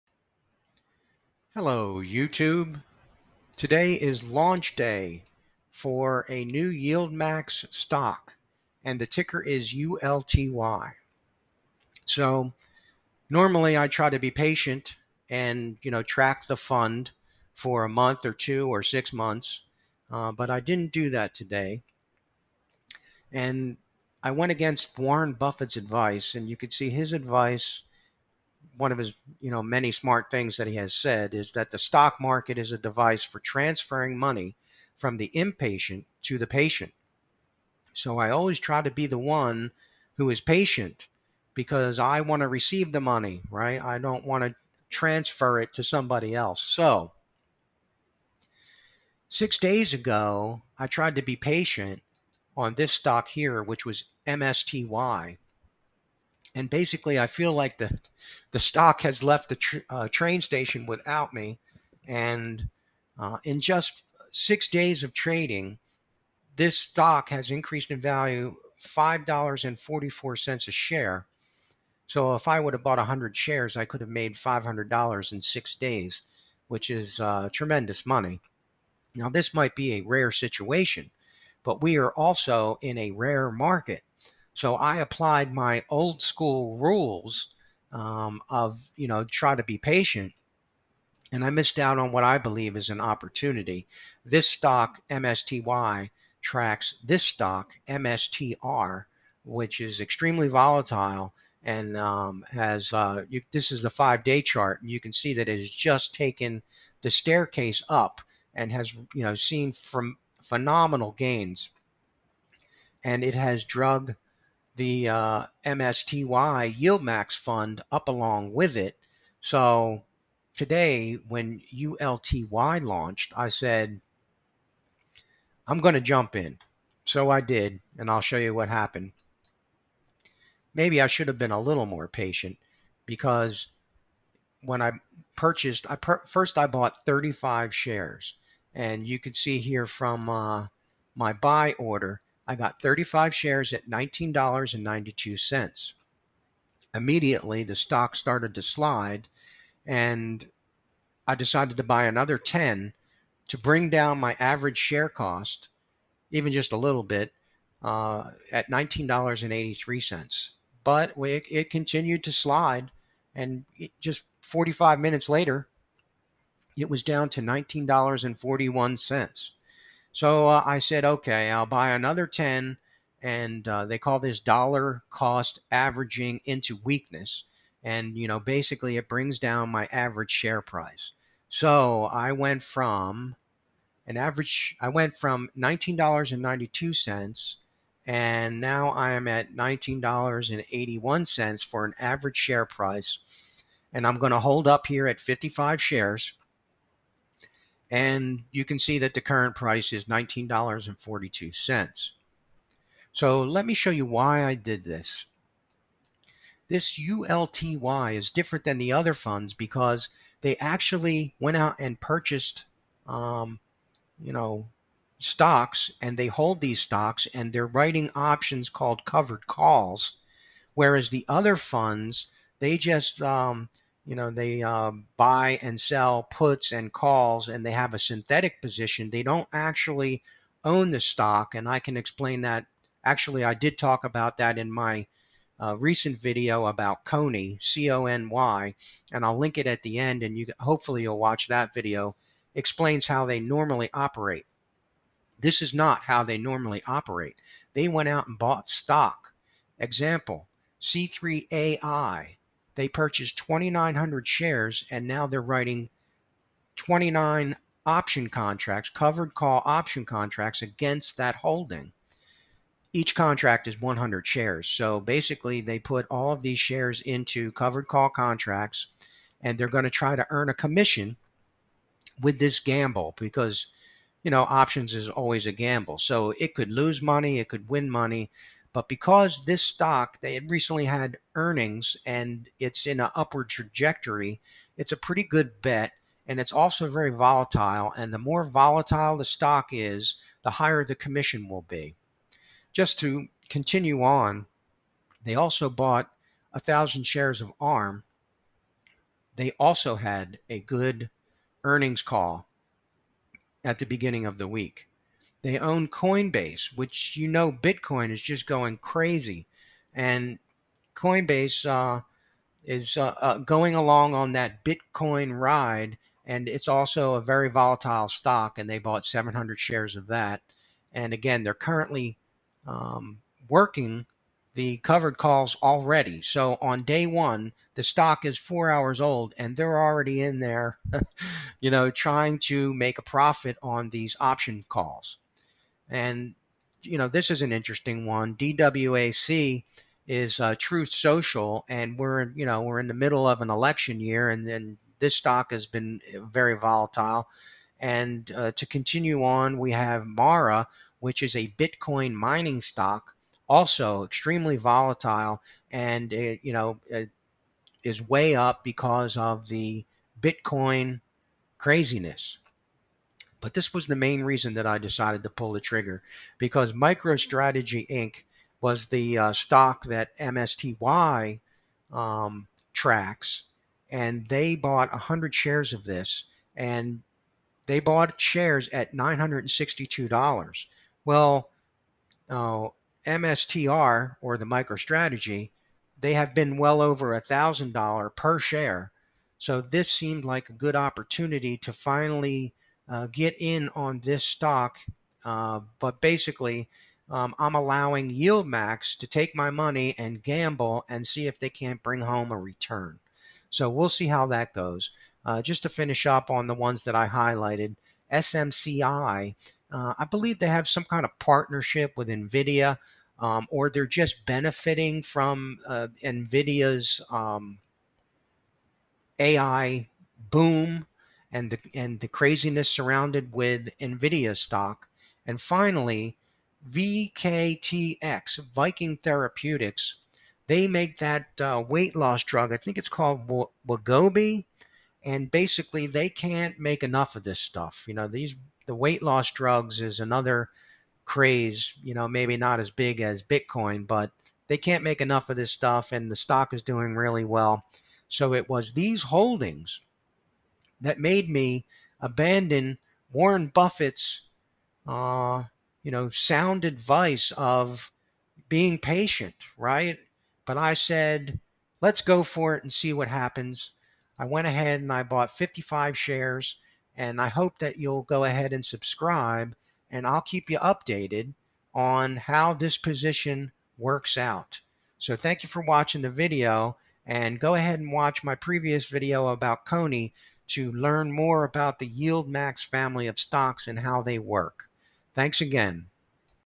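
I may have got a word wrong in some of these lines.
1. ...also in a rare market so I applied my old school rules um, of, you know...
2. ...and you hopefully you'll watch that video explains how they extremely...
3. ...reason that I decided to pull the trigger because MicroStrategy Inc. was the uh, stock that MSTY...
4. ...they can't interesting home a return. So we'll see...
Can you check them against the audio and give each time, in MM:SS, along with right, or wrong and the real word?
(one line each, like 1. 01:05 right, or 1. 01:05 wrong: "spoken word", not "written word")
1. 01:22 right
2. 04:00 wrong: "normally", not "extremely"
3. 06:04 right
4. 06:41 wrong: "bring", not "interesting".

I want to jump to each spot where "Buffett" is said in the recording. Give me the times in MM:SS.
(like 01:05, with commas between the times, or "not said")
00:25, 07:33.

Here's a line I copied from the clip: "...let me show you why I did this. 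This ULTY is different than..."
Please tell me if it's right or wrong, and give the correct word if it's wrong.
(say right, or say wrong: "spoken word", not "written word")
right.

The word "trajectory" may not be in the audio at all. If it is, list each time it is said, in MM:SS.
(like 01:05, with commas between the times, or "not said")
04:43.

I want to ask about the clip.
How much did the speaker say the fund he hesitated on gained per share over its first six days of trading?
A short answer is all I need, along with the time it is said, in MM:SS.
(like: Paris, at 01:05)
$5.44, at 01:08.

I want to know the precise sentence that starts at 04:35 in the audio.
So it could lose money, it could win money.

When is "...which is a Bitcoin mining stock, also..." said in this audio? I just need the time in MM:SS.
05:50.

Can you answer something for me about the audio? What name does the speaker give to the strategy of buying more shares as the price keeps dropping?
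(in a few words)
dollar cost averaging into weakness.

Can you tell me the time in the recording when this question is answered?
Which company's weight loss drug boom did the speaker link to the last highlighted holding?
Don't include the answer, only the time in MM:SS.
07:08.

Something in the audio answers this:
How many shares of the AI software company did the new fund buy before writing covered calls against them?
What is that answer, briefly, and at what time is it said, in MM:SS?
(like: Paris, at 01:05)
2,900, at 04:13.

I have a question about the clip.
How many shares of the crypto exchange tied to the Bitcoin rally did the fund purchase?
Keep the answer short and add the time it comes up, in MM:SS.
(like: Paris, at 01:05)
700, at 05:19.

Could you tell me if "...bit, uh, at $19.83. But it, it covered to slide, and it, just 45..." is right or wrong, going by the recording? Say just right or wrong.
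wrong.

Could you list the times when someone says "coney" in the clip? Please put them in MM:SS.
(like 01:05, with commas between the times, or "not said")
03:57, 07:59.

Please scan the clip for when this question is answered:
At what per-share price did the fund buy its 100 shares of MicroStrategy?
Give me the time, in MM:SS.
06:18.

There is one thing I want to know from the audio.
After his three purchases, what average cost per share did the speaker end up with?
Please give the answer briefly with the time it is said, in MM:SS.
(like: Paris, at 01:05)
$19.81, at 03:09.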